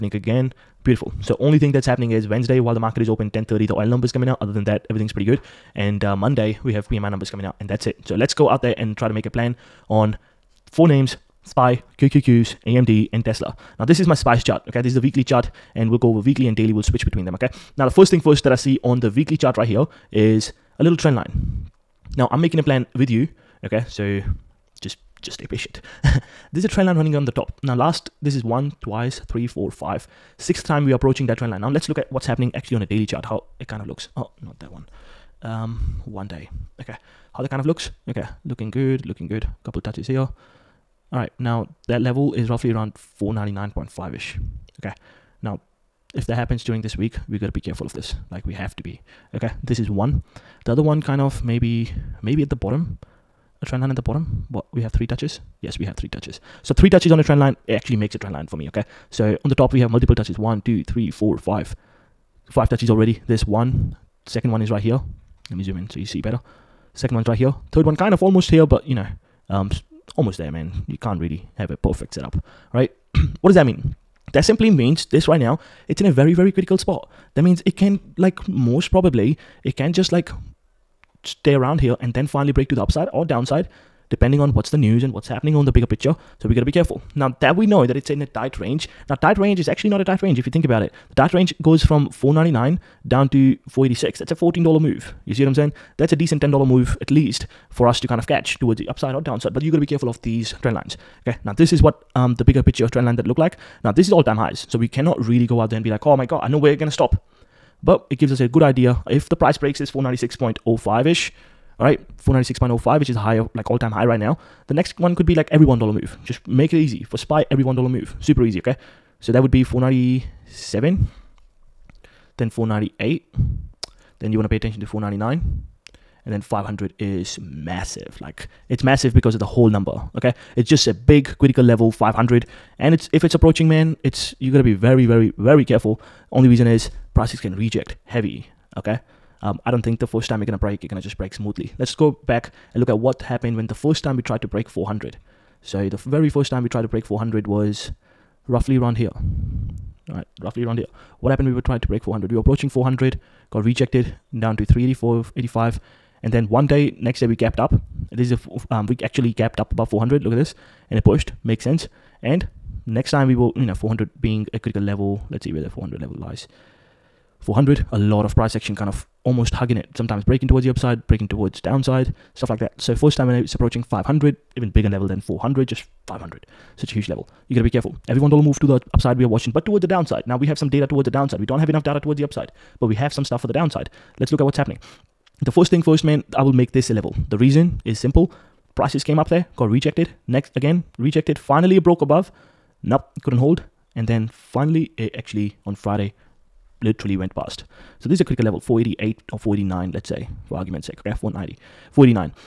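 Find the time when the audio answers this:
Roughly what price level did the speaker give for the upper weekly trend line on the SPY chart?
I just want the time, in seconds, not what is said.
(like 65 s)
42 s.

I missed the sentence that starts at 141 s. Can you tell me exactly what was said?
Let's go back and look at what happened when the first time we tried to break 400.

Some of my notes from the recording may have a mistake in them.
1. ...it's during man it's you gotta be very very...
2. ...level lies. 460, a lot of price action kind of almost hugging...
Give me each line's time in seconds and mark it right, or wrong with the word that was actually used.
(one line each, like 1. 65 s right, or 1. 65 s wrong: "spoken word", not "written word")
1. 133 s wrong: "approaching", not "during"
2. 166 s wrong: "400", not "460".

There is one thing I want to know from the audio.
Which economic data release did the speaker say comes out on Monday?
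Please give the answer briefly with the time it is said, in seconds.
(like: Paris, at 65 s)
PMI numbers, at 6 s.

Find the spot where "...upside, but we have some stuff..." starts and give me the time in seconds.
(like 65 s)
182 s.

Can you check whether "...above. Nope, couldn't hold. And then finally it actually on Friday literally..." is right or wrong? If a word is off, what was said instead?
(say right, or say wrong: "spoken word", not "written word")
right.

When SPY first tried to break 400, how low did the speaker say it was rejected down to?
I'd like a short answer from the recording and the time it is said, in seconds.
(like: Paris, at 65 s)
384, at 154 s.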